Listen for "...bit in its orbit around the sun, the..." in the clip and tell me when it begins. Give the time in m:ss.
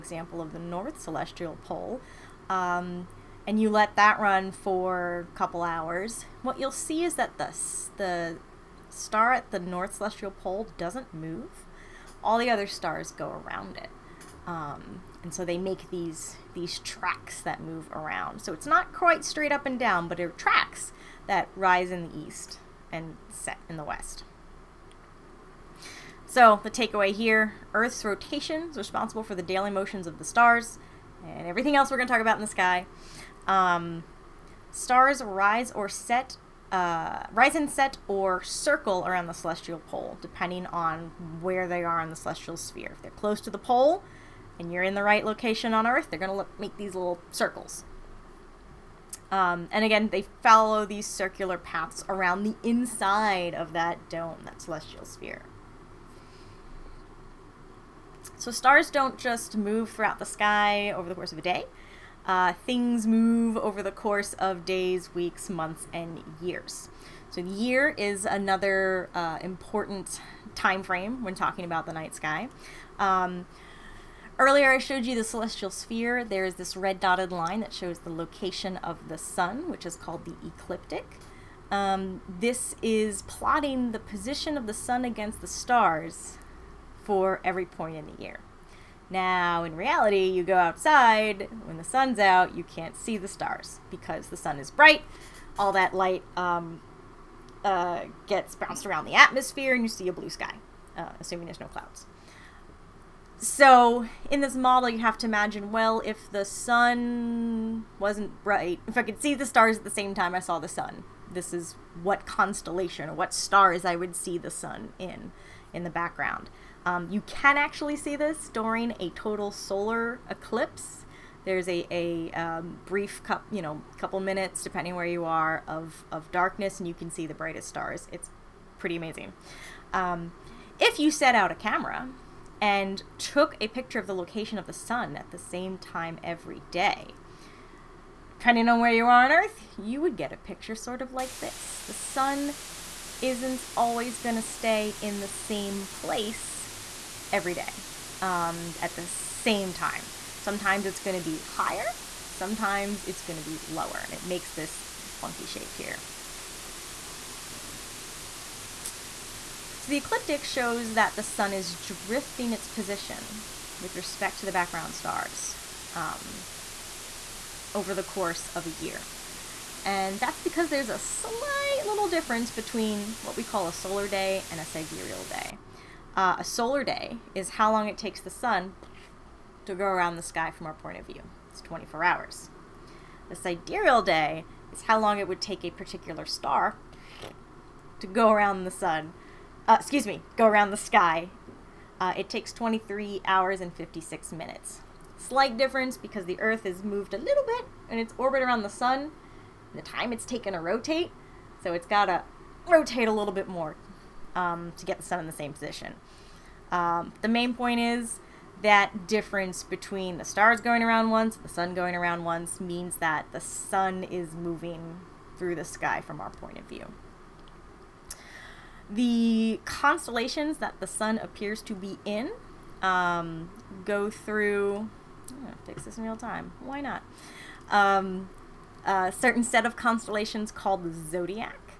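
3:17.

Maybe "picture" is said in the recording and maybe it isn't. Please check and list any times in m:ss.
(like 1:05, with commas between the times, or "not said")
2:13, 2:20.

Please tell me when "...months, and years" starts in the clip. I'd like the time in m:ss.
1:05.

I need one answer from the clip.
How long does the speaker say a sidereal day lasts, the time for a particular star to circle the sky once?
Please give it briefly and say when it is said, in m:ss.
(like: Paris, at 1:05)
23 hours and 56 minutes, at 3:12.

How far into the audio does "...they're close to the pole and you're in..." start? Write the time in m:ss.
0:43.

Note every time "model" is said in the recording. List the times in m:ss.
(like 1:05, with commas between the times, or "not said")
1:44.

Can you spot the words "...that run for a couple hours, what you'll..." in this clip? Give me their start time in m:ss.
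0:03.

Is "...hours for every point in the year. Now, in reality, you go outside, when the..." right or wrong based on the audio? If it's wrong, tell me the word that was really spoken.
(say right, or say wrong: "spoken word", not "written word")
wrong: "stars", not "hours".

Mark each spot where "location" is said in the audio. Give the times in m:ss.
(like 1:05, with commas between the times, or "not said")
0:45, 1:18, 2:14.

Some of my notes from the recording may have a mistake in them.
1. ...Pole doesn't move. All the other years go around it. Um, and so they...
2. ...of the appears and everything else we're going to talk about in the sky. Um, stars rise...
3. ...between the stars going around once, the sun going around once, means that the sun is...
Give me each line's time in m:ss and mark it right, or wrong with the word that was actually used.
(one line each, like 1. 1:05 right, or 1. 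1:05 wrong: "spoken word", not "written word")
1. 0:10 wrong: "stars", not "years"
2. 0:30 wrong: "stars", not "appears"
3. 3:29 right.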